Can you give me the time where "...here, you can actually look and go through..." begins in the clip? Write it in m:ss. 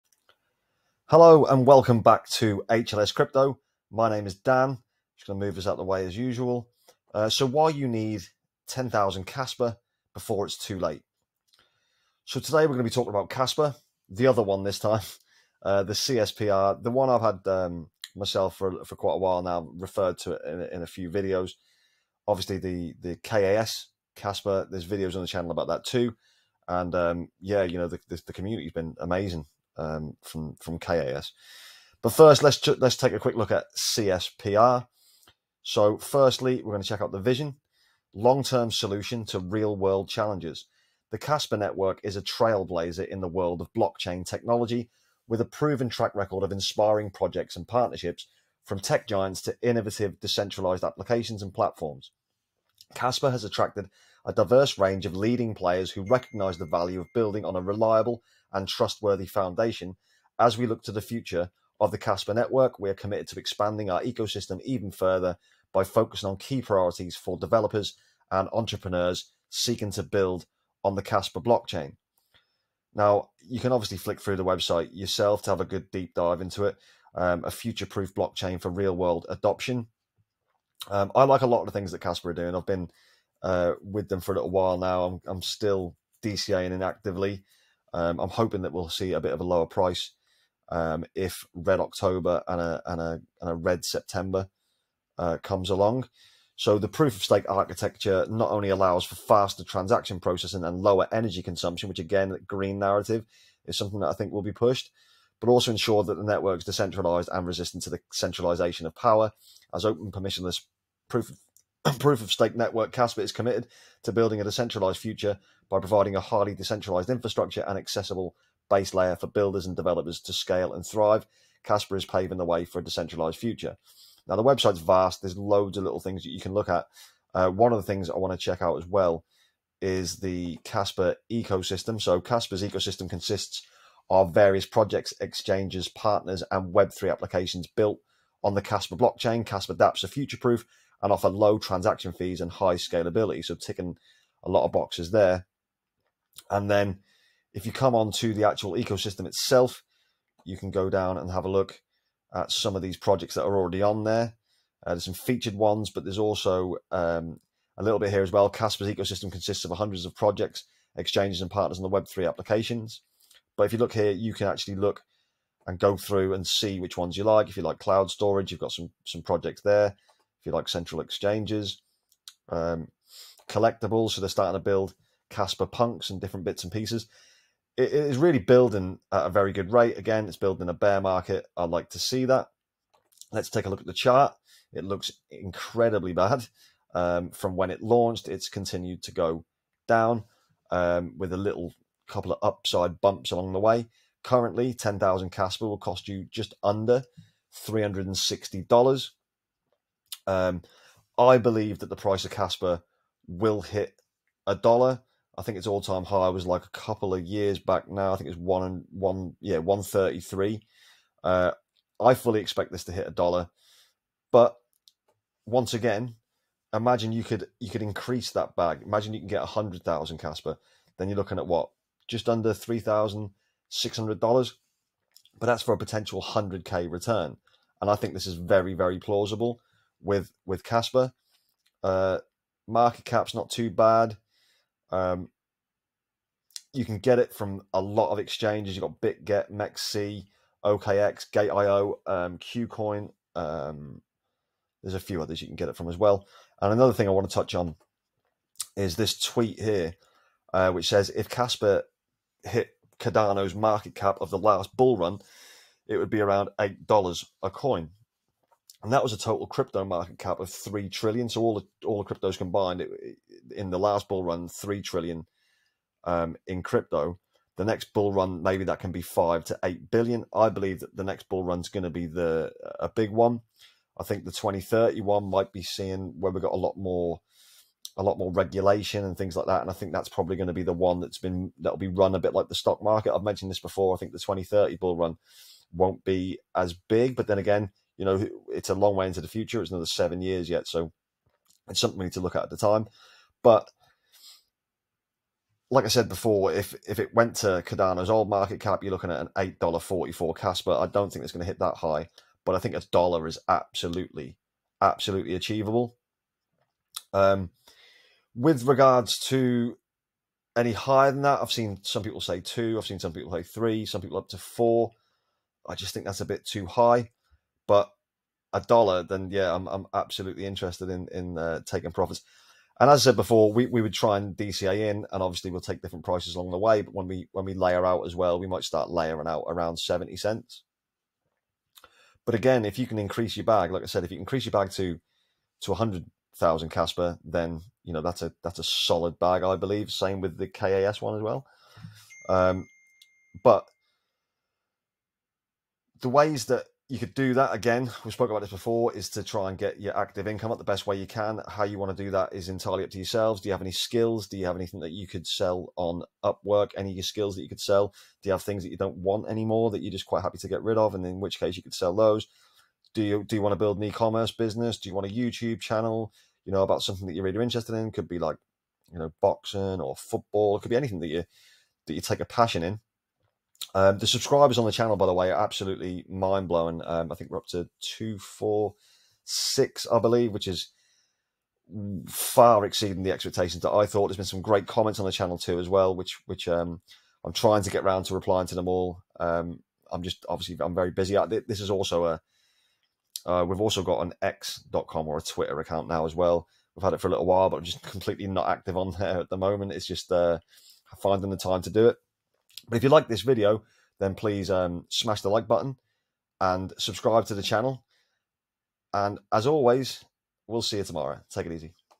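2:43.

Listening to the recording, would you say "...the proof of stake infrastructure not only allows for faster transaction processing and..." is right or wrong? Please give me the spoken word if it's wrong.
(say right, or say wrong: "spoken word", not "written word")
wrong: "architecture", not "infrastructure".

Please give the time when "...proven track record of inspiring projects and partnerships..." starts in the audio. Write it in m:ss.
0:45.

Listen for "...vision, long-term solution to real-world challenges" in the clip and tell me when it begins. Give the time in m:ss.
0:37.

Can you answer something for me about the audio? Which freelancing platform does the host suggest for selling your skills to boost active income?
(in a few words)
Upwork.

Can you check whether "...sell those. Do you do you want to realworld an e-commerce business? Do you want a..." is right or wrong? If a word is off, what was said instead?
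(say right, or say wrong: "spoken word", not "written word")
wrong: "build", not "realworld".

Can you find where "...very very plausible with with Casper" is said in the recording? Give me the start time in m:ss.
3:48.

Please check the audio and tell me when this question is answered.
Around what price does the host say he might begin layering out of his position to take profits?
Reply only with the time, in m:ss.
5:29.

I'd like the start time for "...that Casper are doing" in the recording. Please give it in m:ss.
1:21.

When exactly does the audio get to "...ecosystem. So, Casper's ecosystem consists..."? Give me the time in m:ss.
2:11.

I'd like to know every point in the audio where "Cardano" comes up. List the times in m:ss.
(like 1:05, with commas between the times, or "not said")
4:12, 4:57.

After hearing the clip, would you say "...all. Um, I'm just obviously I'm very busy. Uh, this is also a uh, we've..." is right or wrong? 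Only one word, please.
right.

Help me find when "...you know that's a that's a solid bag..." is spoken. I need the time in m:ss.
5:37.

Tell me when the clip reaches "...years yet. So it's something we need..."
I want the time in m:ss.
4:50.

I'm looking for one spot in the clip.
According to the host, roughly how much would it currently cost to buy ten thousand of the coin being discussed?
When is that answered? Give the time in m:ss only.
3:16.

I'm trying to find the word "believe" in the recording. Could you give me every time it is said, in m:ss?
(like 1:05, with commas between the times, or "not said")
3:21, 4:30, 5:39, 6:19.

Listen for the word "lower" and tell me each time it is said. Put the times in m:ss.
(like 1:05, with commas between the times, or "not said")
1:29, 1:40.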